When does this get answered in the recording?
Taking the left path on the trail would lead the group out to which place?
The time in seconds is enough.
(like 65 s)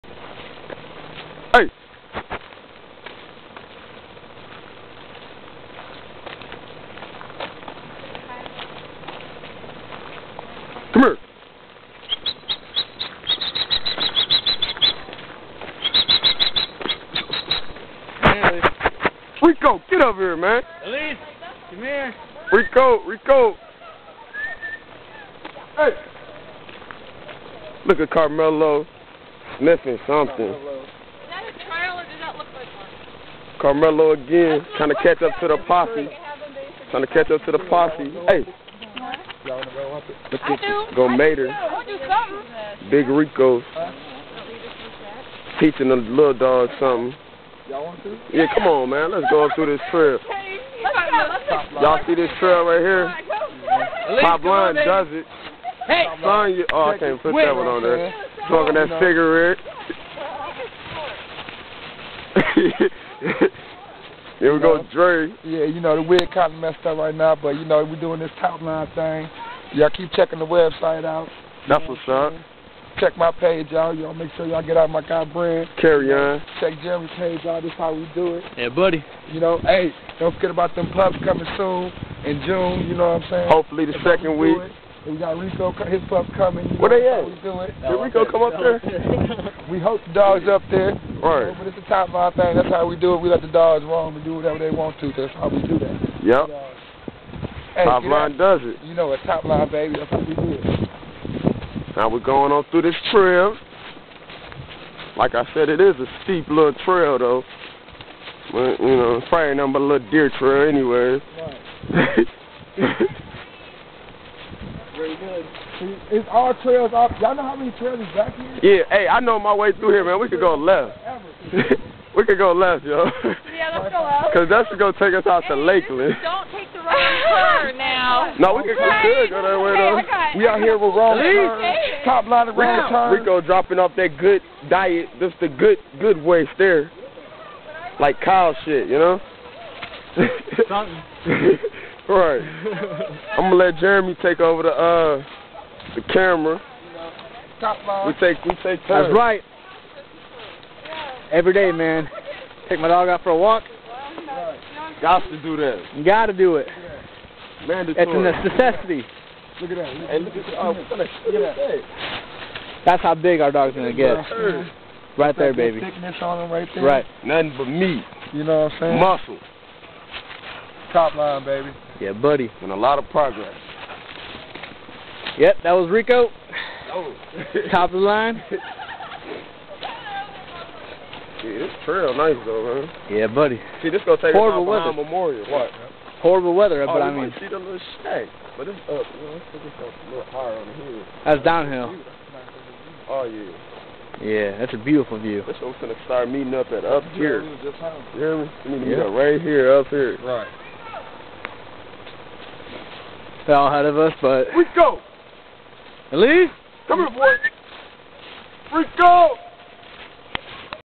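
125 s.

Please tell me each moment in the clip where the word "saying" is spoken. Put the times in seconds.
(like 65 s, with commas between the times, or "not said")
83 s, 168 s.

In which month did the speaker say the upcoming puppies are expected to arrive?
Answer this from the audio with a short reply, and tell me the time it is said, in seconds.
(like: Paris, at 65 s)
June, at 82 s.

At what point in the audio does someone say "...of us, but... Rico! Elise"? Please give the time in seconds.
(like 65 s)
203 s.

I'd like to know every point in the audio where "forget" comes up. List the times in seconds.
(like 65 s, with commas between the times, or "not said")
80 s.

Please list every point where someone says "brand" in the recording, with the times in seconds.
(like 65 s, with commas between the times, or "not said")
75 s.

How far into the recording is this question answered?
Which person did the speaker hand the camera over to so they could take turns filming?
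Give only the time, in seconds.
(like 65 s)
143 s.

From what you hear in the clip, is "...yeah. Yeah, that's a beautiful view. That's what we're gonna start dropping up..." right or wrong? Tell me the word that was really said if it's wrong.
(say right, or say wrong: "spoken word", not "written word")
wrong: "meeting", not "dropping".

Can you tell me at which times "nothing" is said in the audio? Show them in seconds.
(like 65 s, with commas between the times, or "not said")
109 s, 167 s.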